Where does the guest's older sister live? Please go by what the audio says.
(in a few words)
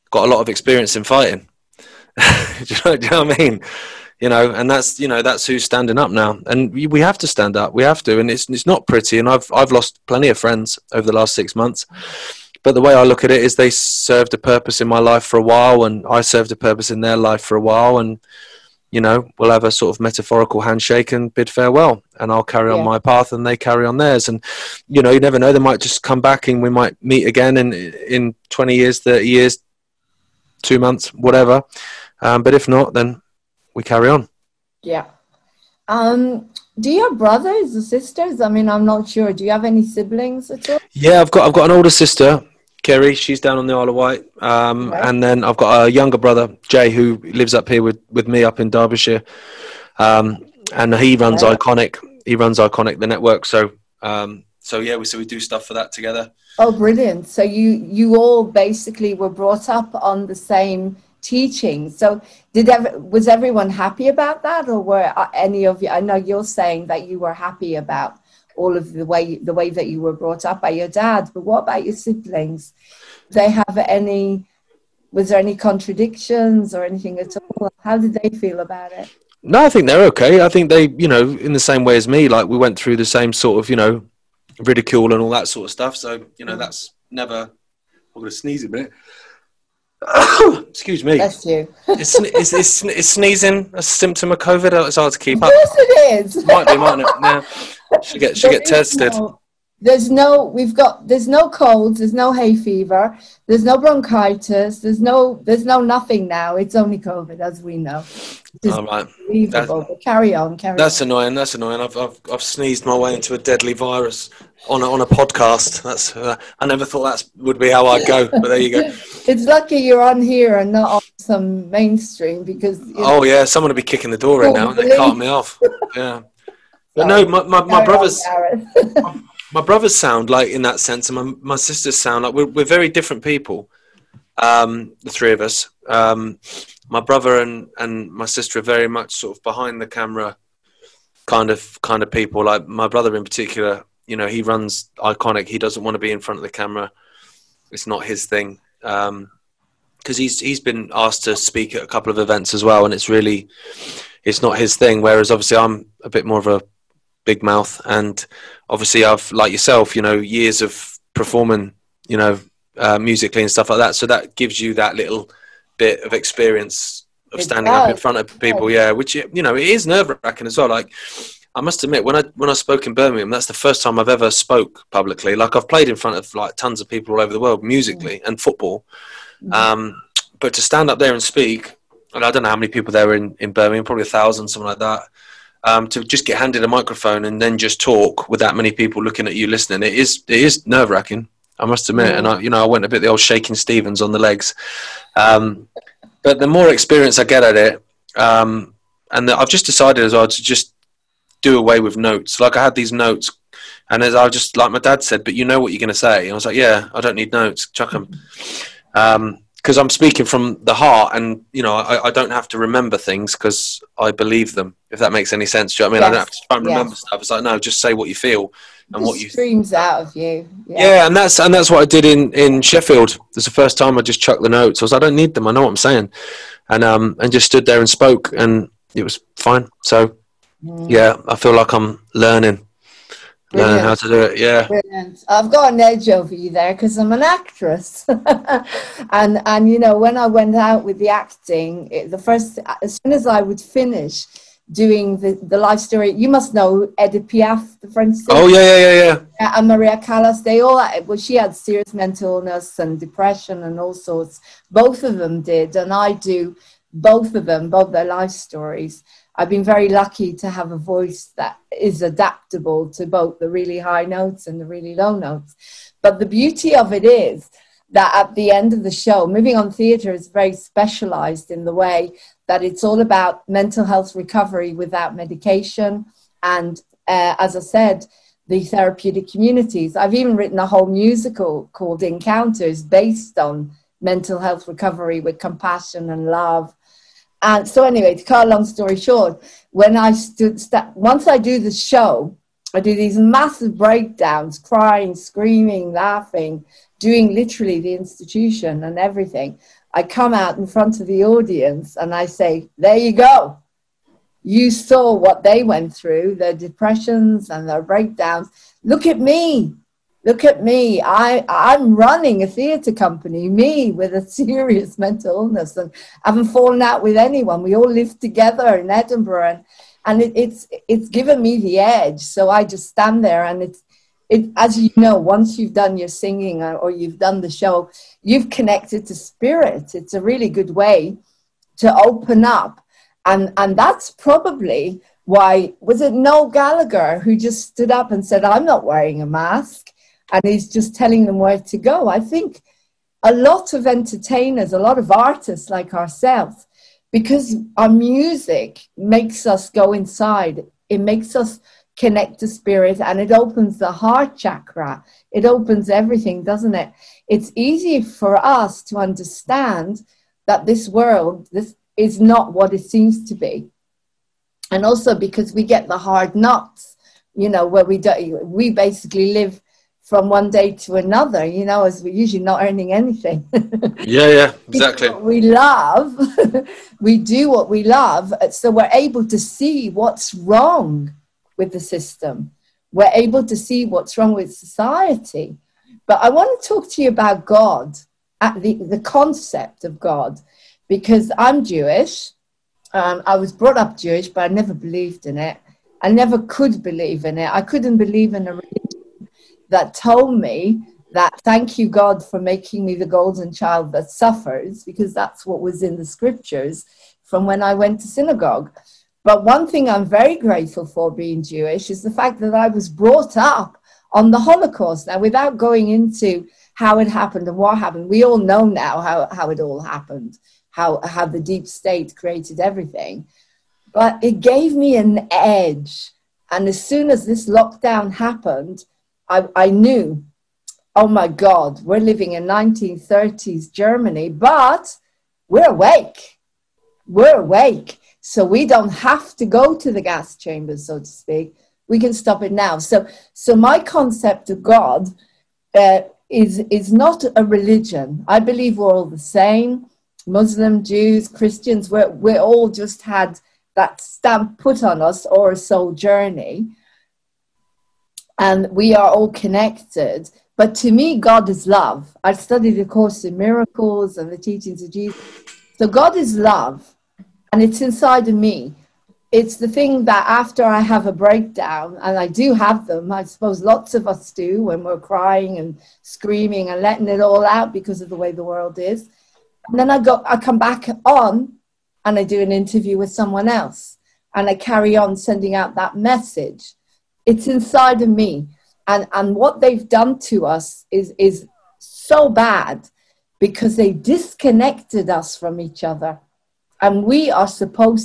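Isle of Wight.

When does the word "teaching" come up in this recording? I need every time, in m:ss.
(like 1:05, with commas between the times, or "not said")
1:01, 7:44.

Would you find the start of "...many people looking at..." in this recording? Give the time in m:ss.
3:08.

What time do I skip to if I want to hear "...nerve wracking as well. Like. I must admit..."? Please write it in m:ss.
2:49.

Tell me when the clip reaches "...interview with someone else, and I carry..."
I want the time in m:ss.
8:02.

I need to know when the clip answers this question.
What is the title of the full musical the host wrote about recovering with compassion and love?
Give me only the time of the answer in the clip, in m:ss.
4:42.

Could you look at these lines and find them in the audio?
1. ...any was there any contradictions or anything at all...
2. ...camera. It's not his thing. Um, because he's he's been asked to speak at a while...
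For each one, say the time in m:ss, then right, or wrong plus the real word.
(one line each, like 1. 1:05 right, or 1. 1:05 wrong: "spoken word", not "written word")
1. 1:13 right
2. 2:26 wrong: "couple", not "while".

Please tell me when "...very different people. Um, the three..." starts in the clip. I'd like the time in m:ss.
2:12.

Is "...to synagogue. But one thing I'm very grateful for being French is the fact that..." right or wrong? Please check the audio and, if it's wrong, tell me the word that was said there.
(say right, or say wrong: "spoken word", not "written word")
wrong: "Jewish", not "French".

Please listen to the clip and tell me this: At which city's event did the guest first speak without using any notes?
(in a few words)
Sheffield.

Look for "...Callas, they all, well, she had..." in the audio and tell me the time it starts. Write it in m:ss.
4:09.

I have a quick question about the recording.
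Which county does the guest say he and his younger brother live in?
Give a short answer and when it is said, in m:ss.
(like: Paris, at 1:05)
Derbyshire, at 0:48.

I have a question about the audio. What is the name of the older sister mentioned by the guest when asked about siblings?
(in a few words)
Kerry.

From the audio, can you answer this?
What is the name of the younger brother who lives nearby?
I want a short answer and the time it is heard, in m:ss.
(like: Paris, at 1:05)
Jay, at 0:46.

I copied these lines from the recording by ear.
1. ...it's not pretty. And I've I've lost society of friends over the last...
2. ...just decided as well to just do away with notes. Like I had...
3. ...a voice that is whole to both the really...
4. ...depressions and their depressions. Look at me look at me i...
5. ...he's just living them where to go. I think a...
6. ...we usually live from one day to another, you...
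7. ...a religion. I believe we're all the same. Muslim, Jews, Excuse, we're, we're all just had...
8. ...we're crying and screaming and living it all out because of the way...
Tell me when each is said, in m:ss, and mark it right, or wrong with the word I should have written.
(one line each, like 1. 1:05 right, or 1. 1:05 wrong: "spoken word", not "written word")
1. 0:08 wrong: "plenty", not "society"
2. 3:19 right
3. 4:20 wrong: "adaptable", not "whole"
4. 5:06 wrong: "breakdowns", not "depressions"
5. 5:40 wrong: "telling", not "living"
6. 6:08 wrong: "basically", not "usually"
7. 7:27 wrong: "Christians", not "Excuse"
8. 7:54 wrong: "letting", not "living".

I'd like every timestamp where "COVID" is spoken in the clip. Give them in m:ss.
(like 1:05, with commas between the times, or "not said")
1:34, 1:46.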